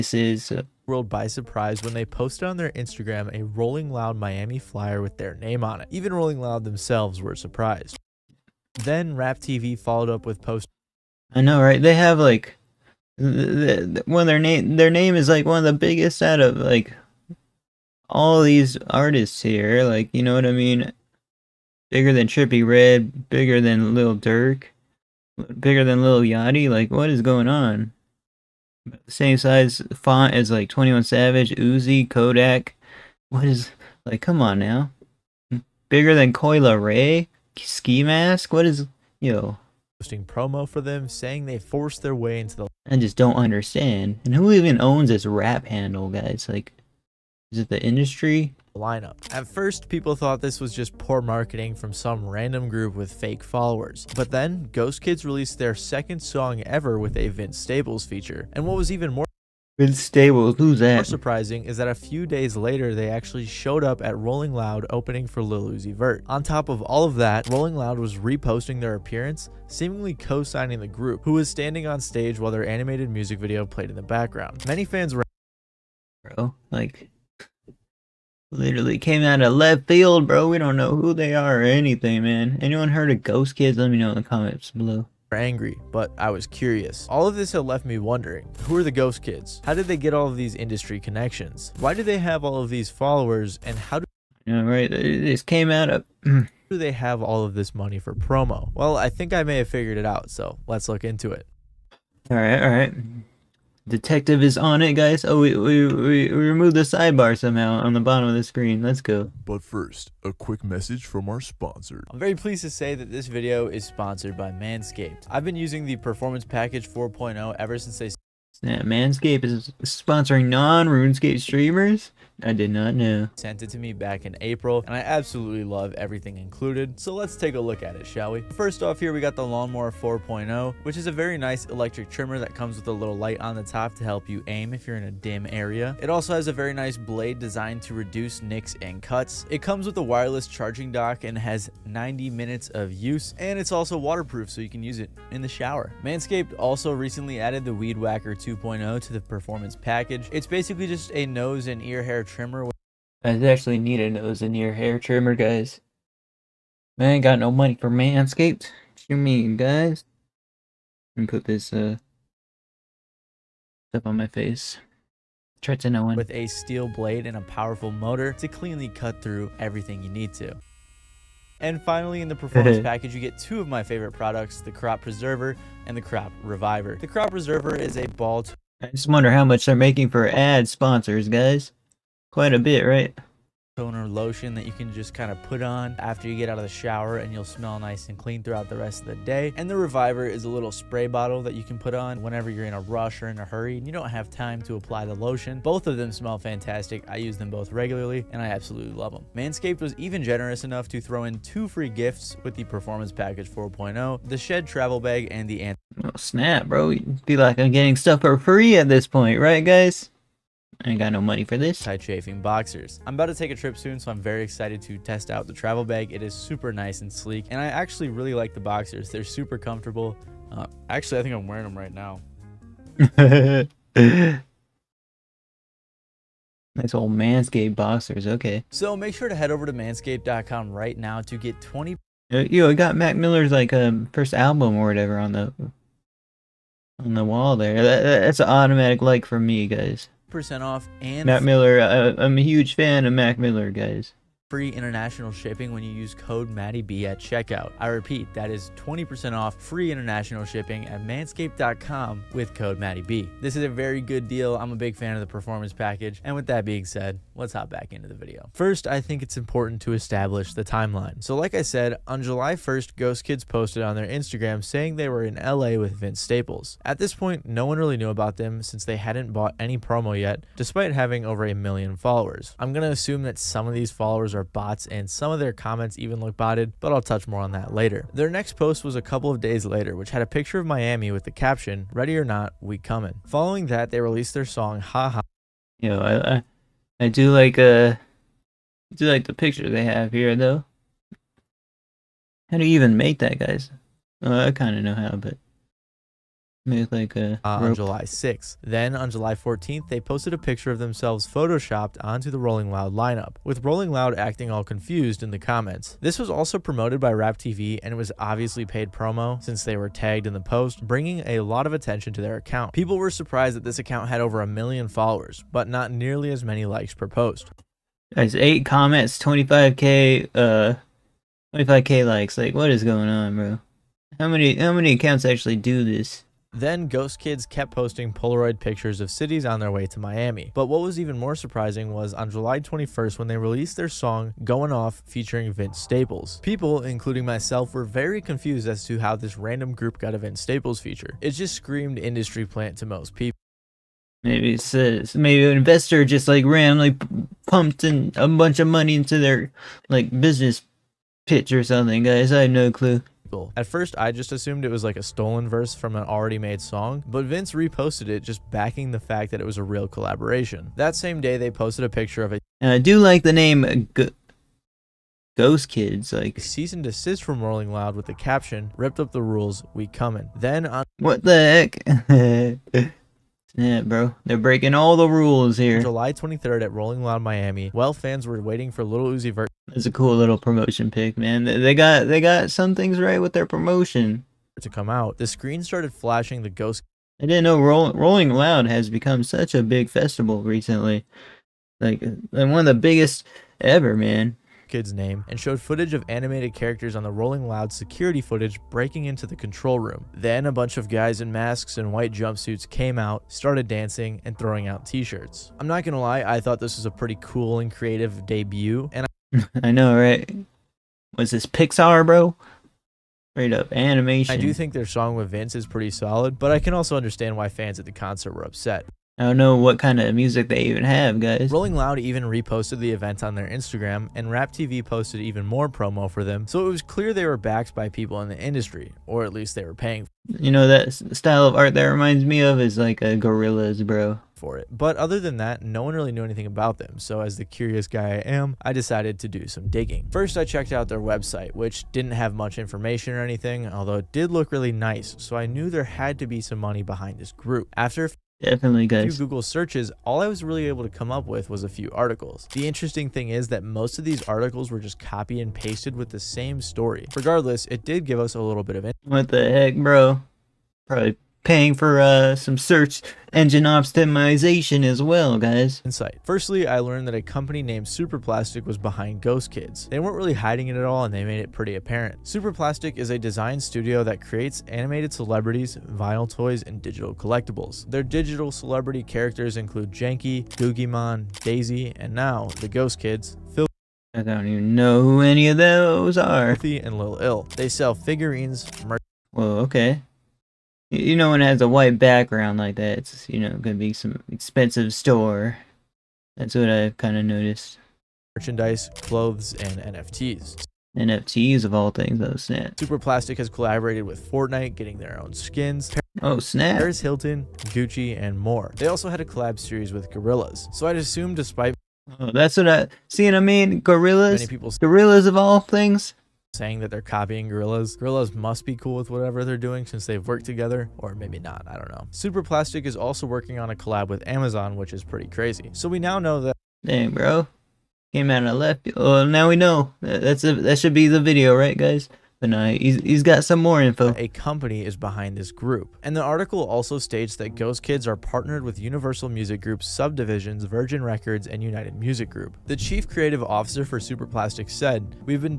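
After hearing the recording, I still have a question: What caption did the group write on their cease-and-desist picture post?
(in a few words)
Ripped up the rules, we coming.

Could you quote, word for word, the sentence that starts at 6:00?
That same day, they posted a picture of it.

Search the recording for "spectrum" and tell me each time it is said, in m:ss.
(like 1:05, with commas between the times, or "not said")
not said.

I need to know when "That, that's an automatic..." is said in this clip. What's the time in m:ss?
3:57.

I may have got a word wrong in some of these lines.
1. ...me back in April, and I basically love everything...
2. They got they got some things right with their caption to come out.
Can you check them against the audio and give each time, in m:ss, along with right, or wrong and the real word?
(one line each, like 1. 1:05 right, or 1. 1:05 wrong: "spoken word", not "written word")
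1. 2:03 wrong: "absolutely", not "basically"
2. 6:21 wrong: "promotion", not "caption".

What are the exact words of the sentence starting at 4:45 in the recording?
You know, I, I, I do like uh, I do like the picture they have here though.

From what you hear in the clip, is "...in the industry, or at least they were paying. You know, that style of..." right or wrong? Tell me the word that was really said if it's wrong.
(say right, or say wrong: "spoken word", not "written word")
right.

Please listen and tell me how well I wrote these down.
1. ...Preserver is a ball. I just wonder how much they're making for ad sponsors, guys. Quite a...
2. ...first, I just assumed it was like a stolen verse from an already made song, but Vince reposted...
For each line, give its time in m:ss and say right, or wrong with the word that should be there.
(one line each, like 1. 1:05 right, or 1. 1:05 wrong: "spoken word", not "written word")
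1. 2:57 right
2. 5:53 right.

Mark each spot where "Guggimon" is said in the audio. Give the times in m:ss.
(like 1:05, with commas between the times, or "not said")
8:00.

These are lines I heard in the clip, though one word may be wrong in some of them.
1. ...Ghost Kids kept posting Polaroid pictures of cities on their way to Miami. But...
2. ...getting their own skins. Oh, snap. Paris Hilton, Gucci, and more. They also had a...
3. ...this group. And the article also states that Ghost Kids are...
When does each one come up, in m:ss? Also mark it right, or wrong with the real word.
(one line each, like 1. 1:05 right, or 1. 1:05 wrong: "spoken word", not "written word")
1. 5:26 right
2. 8:24 right
3. 8:55 right.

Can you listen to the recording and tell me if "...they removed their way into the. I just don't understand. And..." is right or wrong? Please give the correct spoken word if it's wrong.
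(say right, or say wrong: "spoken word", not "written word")
wrong: "forced", not "removed".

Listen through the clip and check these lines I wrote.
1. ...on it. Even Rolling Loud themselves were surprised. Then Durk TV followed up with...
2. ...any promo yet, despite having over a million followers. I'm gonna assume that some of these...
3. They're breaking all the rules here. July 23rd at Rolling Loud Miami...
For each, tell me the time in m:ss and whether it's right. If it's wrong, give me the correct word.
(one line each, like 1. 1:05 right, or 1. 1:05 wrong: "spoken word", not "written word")
1. 0:05 wrong: "Rap", not "Durk"
2. 4:29 right
3. 6:14 right.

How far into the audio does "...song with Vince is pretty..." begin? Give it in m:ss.
6:54.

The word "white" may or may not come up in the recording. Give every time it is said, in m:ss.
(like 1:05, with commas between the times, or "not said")
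6:41, 8:11.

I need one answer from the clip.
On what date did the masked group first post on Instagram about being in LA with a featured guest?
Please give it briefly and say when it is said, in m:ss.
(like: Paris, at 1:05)
July 1st, at 4:22.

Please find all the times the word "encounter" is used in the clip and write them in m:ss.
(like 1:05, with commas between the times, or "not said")
not said.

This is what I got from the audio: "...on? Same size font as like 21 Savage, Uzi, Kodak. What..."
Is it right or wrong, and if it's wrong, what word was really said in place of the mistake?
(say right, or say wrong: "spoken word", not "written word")
right.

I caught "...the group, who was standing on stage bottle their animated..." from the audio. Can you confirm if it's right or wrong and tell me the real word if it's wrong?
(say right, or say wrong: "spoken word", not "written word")
wrong: "while", not "bottle".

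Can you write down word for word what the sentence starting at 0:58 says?
And what was even more Vince Staples, who's that?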